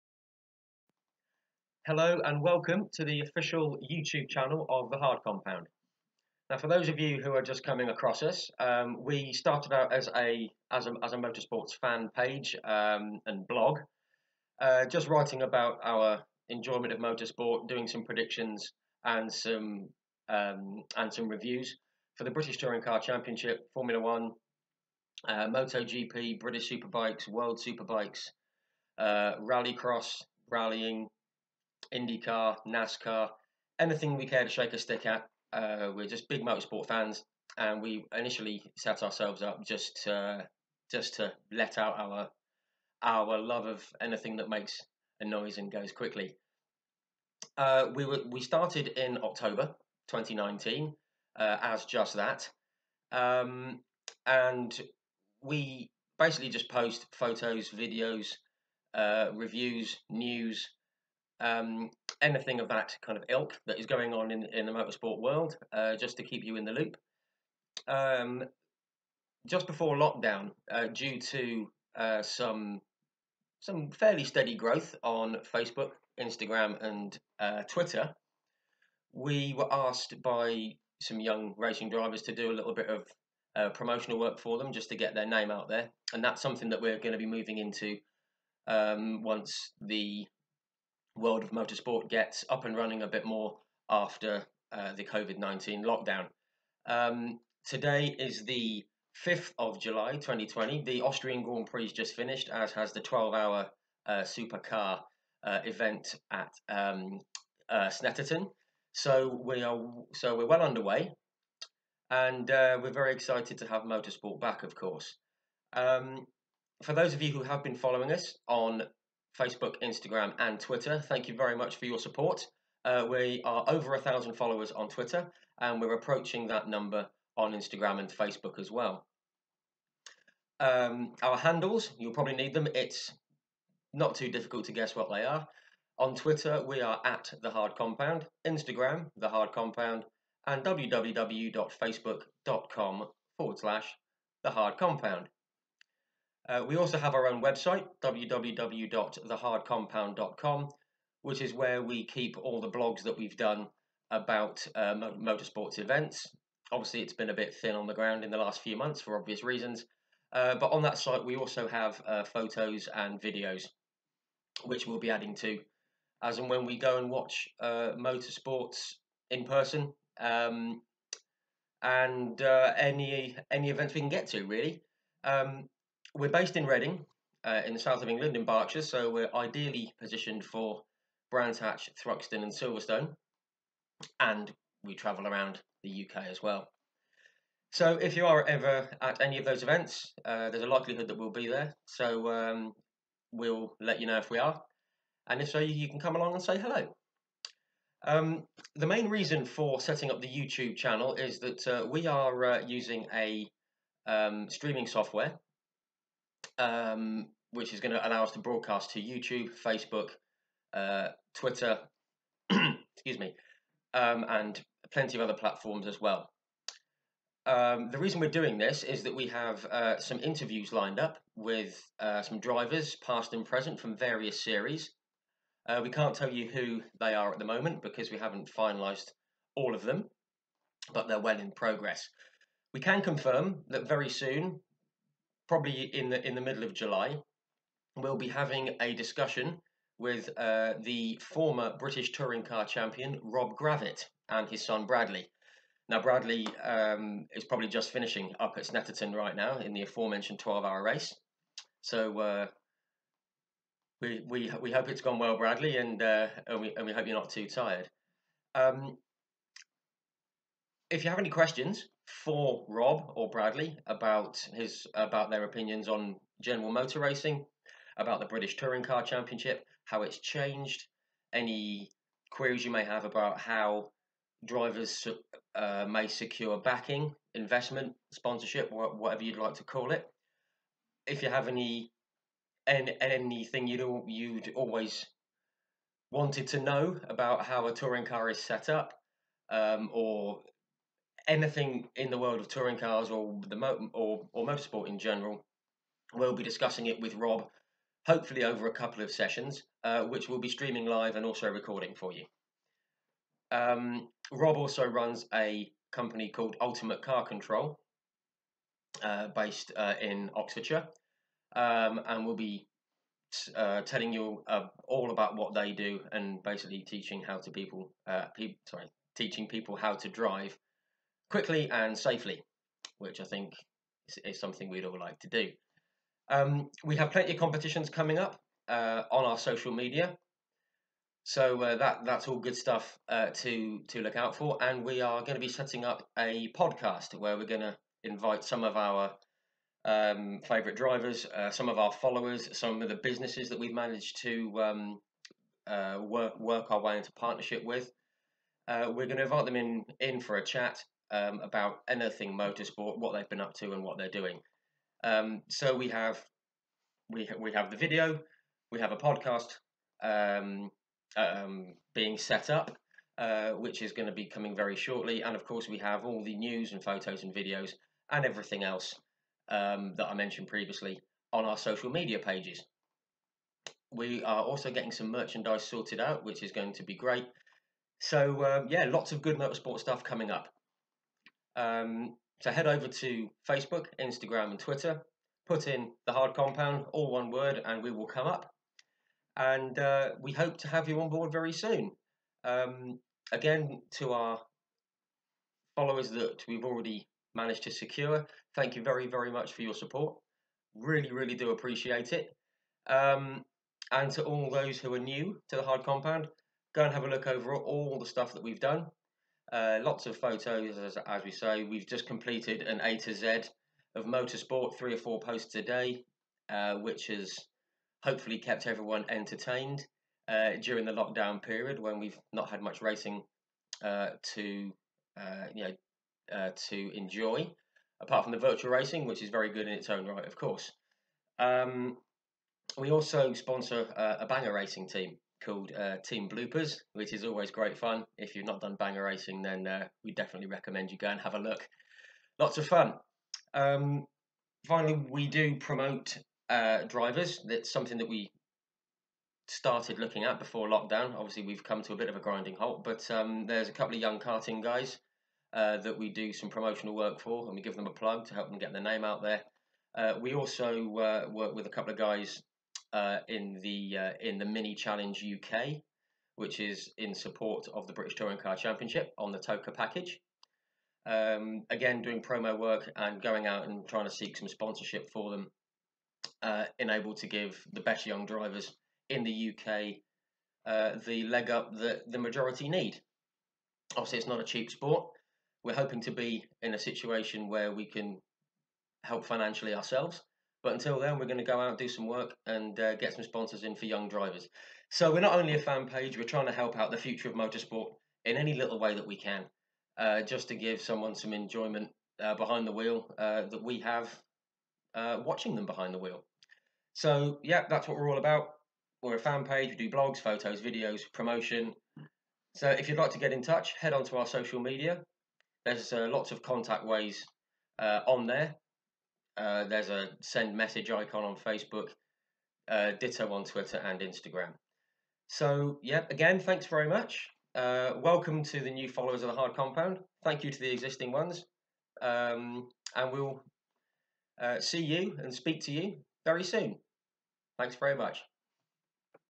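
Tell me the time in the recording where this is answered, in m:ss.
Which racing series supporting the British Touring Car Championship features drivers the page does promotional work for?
7:44.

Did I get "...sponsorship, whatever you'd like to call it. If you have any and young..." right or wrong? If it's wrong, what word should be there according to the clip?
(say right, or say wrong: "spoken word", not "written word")
wrong: "anything", not "young".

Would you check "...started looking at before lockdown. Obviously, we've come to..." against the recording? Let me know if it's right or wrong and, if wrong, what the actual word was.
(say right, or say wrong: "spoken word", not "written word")
right.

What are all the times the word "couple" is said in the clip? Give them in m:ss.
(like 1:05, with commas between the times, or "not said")
4:58, 7:33, 7:41.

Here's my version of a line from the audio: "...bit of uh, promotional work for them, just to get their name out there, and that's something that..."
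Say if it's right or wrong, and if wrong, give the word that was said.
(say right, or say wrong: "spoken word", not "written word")
right.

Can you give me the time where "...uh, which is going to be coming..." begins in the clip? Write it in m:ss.
6:03.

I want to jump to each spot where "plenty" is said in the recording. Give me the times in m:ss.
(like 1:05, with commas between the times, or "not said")
3:34, 5:27.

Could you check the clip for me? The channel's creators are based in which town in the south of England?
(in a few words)
Reading.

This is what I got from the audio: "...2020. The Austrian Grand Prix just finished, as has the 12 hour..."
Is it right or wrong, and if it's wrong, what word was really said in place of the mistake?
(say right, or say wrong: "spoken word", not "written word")
right.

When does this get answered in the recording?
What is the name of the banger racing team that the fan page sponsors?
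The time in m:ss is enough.
7:15.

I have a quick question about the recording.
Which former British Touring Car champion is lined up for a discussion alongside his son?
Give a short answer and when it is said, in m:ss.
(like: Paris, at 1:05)
Rob Gravett, at 4:03.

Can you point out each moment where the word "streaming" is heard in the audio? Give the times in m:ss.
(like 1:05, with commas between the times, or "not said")
3:24, 5:00.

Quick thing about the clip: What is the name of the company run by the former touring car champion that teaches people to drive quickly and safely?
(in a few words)
Ultimate Car Control.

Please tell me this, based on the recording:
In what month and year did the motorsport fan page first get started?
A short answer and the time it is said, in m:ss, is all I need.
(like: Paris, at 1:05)
October 2019, at 0:49.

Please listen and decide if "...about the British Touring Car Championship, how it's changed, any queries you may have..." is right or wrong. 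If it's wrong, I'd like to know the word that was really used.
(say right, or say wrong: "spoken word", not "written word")
right.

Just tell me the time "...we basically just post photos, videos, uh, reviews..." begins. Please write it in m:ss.
0:55.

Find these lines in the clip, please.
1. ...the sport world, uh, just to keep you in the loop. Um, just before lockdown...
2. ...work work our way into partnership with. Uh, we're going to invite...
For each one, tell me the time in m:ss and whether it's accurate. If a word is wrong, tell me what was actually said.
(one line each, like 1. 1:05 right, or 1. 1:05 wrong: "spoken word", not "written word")
1. 1:04 wrong: "motorsport", not "sport"
2. 5:46 right.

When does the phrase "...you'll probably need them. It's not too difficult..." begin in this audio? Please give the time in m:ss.
2:11.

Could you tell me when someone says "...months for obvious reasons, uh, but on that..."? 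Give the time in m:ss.
2:38.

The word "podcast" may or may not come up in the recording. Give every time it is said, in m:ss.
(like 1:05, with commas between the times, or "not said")
5:36, 5:58.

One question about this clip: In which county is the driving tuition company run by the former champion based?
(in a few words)
Oxfordshire.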